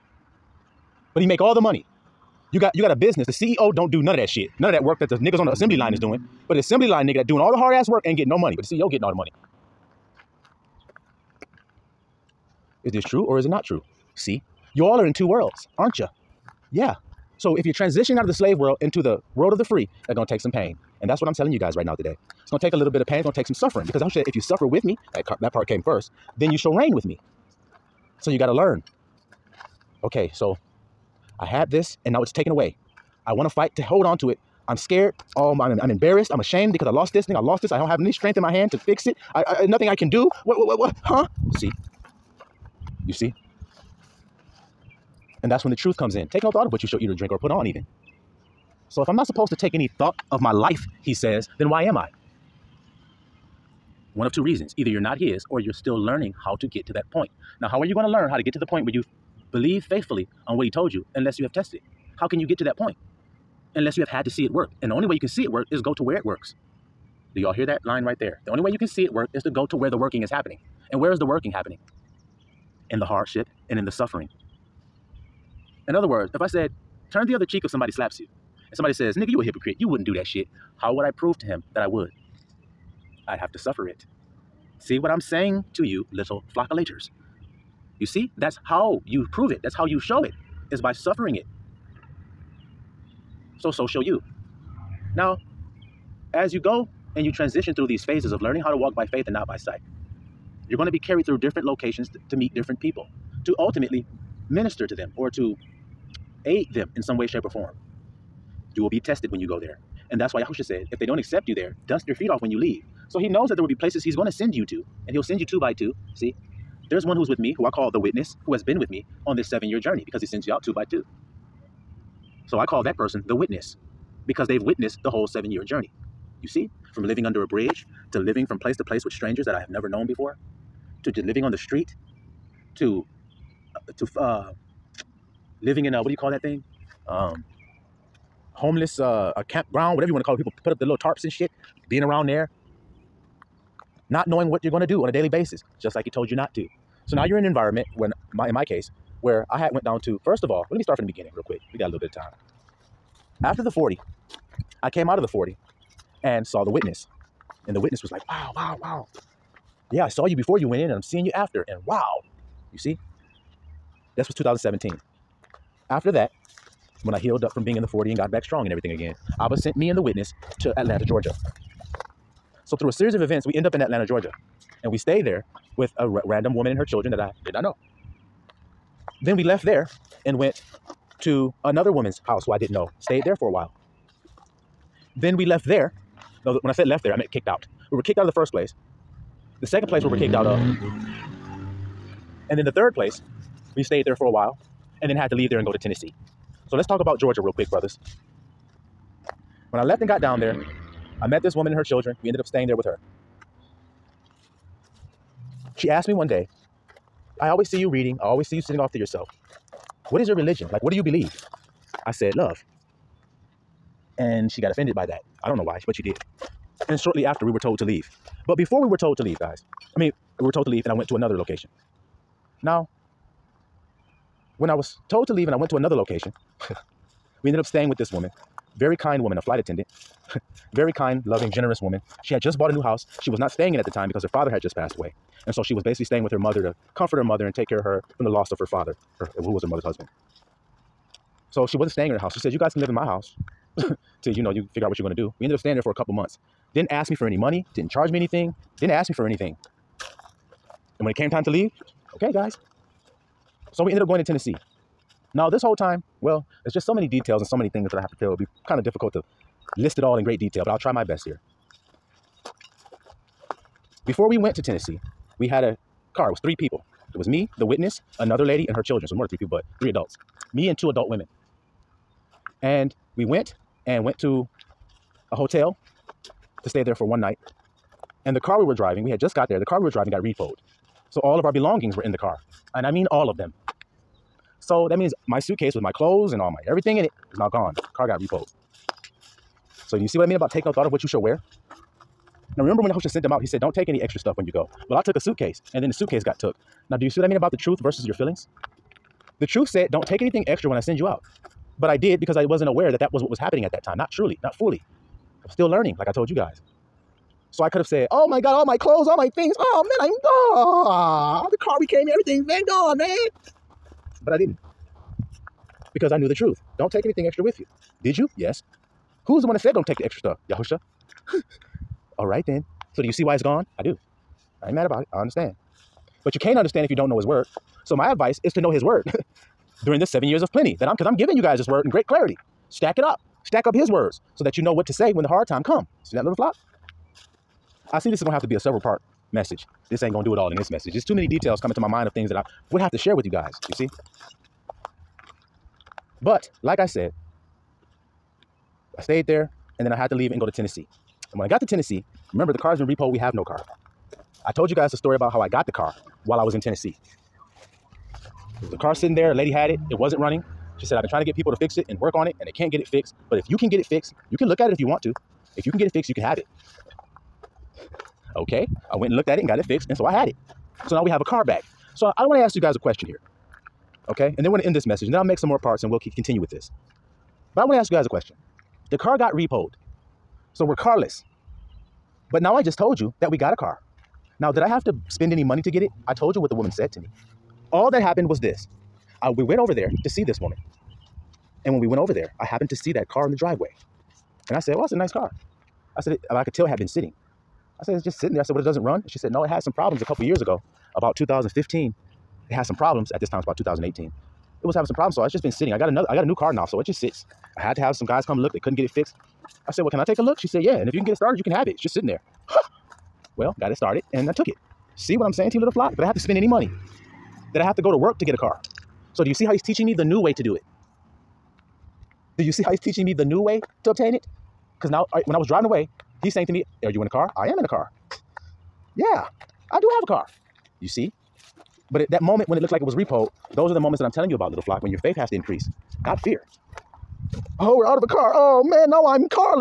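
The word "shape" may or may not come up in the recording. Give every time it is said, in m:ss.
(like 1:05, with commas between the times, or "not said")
1:47.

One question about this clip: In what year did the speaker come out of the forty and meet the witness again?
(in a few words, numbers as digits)
2017.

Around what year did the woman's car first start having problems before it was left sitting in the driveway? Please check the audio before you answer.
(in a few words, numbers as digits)
2015.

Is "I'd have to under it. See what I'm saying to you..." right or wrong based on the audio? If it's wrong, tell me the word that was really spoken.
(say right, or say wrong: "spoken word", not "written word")
wrong: "suffer", not "under".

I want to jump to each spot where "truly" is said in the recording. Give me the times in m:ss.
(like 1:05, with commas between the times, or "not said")
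5:04.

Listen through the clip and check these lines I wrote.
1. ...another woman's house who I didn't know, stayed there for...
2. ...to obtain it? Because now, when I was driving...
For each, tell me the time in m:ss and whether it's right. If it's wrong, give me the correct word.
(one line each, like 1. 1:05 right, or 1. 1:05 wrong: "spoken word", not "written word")
1. 3:01 right
2. 7:03 right.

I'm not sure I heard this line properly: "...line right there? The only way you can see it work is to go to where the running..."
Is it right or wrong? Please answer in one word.
wrong.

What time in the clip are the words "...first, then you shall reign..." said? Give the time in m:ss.
0:25.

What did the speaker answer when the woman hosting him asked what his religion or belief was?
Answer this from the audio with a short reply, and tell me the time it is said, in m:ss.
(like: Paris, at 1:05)
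Love, at 3:32.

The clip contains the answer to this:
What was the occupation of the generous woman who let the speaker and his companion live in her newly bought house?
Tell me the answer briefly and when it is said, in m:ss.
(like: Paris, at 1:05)
Flight attendant, at 3:49.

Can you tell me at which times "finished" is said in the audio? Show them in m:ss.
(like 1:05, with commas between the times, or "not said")
not said.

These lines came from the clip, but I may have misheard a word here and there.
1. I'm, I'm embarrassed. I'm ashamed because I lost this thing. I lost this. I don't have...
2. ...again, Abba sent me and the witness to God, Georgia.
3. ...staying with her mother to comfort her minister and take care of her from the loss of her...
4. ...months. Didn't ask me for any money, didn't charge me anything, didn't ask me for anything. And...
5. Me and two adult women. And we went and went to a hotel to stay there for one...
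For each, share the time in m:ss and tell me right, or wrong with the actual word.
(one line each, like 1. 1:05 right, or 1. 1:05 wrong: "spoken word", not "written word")
1. 0:35 right
2. 2:48 wrong: "Atlanta", not "God"
3. 3:56 wrong: "mother", not "minister"
4. 4:06 right
5. 4:30 right.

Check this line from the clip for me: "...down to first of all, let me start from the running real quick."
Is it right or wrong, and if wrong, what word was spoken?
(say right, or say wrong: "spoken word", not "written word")
wrong: "beginning", not "running".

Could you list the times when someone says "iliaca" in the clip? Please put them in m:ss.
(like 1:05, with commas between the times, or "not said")
not said.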